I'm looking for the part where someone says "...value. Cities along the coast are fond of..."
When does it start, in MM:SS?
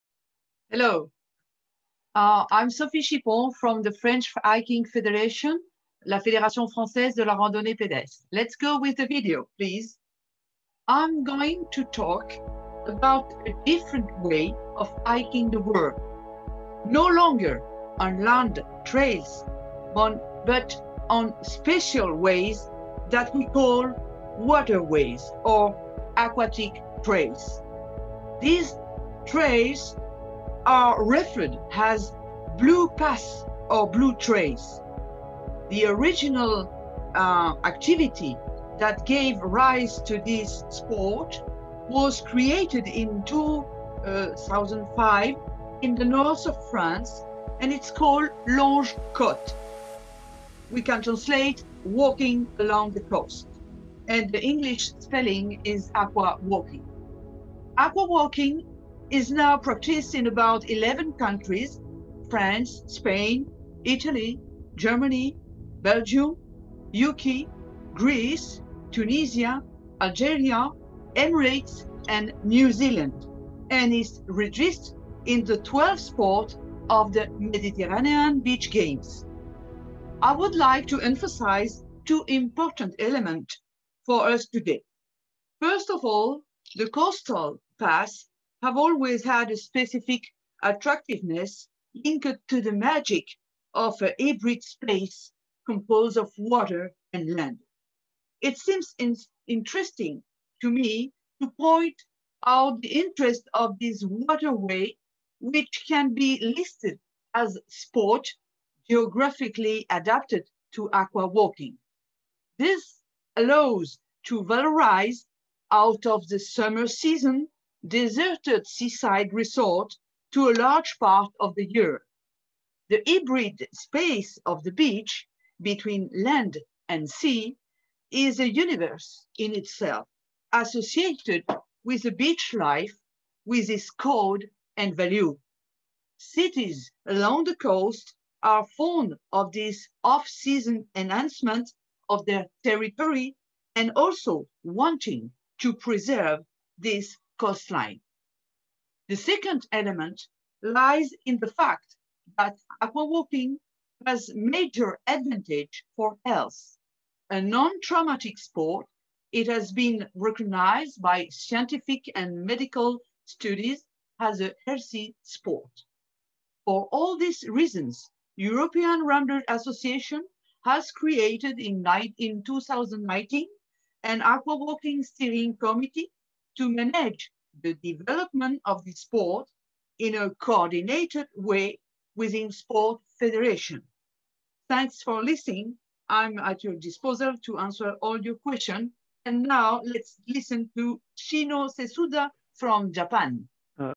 02:14.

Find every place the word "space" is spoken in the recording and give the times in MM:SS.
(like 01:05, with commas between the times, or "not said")
01:34, 02:03.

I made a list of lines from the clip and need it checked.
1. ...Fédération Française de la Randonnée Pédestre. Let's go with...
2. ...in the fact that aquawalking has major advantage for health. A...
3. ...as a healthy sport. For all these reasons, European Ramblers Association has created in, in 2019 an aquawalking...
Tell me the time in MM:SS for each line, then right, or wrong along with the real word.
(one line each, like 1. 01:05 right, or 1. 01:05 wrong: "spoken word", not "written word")
1. 00:06 right
2. 02:31 right
3. 02:44 right.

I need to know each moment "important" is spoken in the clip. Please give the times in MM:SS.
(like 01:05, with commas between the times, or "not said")
01:22.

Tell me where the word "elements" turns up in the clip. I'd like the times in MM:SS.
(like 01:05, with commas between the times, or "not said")
01:22, 02:29.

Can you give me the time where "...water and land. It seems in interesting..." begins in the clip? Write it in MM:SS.
01:36.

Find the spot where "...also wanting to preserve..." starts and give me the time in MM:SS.
02:23.